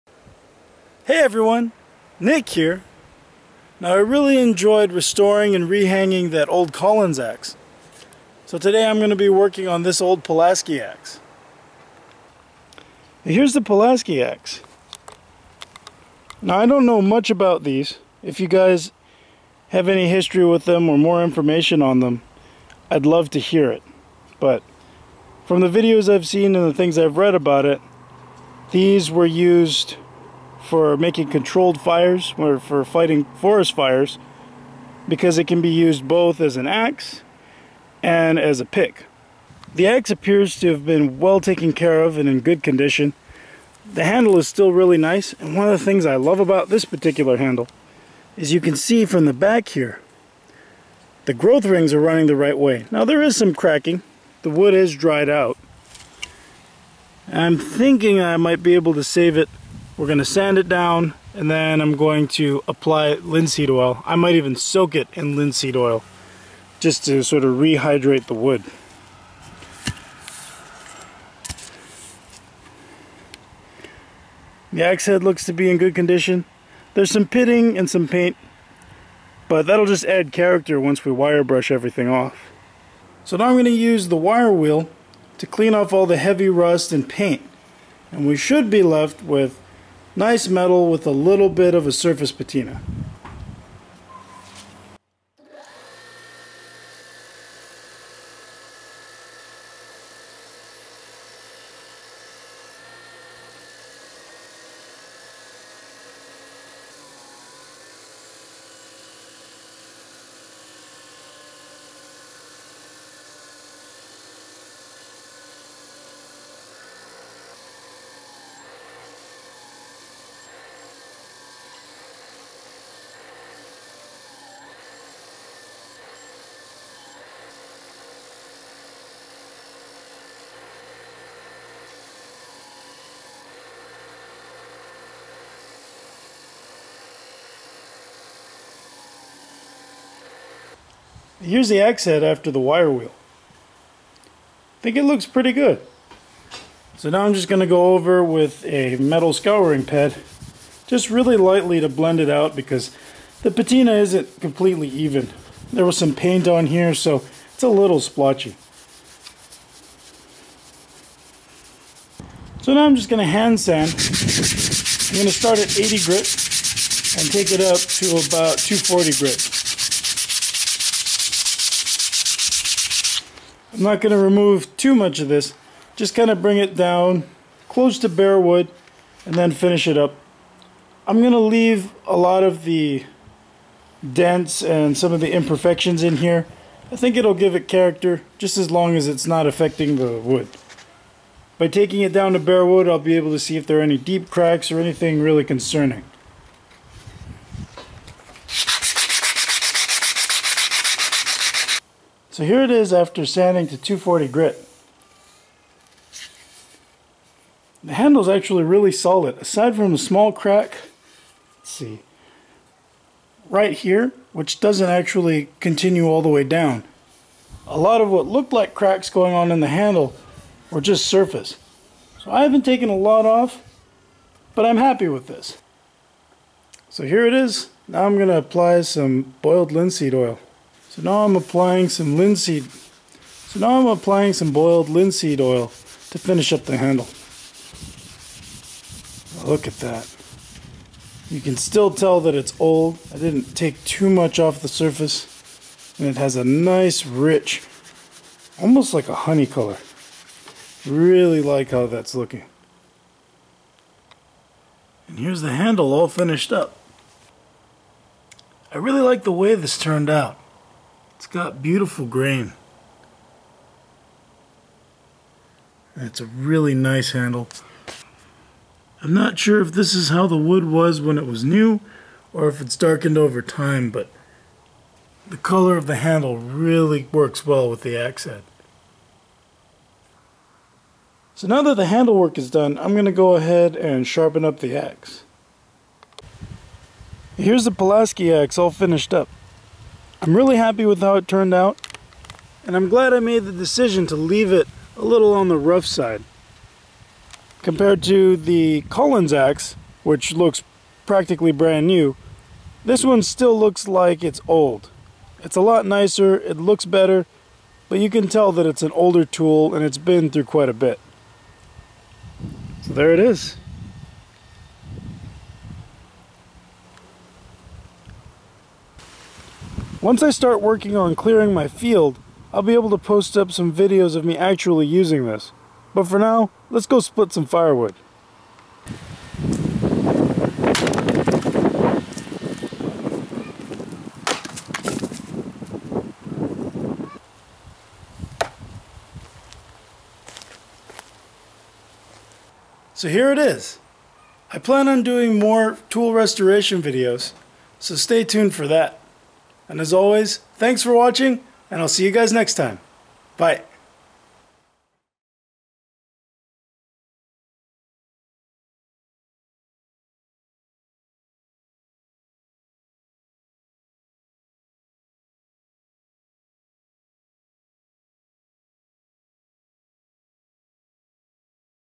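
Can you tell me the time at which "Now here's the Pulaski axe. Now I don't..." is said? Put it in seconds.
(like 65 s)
13 s.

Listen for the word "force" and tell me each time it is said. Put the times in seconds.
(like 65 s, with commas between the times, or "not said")
not said.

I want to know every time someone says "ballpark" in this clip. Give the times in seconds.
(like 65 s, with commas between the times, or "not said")
not said.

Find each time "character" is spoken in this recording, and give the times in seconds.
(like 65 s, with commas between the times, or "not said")
80 s, 187 s.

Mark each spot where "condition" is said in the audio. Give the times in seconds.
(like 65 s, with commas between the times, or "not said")
42 s, 75 s.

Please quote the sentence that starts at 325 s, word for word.
But for now, let's go split some firewood.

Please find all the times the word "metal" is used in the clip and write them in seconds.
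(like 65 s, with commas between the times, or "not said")
90 s, 148 s.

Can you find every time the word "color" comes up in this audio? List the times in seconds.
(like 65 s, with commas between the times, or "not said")
249 s, 275 s.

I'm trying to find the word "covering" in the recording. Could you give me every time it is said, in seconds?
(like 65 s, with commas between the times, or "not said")
not said.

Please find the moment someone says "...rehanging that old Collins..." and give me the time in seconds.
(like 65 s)
5 s.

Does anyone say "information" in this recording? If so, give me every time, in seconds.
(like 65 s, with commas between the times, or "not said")
21 s.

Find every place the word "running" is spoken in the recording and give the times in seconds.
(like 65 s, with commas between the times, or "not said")
51 s.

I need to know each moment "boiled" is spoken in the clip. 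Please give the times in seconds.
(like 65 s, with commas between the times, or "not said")
229 s, 234 s.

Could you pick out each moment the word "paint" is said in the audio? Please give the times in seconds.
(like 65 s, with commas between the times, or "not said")
78 s, 87 s, 156 s.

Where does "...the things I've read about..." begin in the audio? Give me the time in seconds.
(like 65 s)
26 s.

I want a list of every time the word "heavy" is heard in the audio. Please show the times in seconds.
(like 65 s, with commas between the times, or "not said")
86 s.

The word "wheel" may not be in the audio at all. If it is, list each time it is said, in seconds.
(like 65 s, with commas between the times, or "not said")
84 s, 142 s.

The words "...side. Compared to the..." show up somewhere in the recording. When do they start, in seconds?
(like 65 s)
295 s.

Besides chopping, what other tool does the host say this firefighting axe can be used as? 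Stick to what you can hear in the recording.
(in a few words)
a pick.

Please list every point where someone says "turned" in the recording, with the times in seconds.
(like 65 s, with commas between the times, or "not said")
259 s, 291 s.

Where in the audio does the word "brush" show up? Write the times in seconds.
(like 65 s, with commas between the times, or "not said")
81 s.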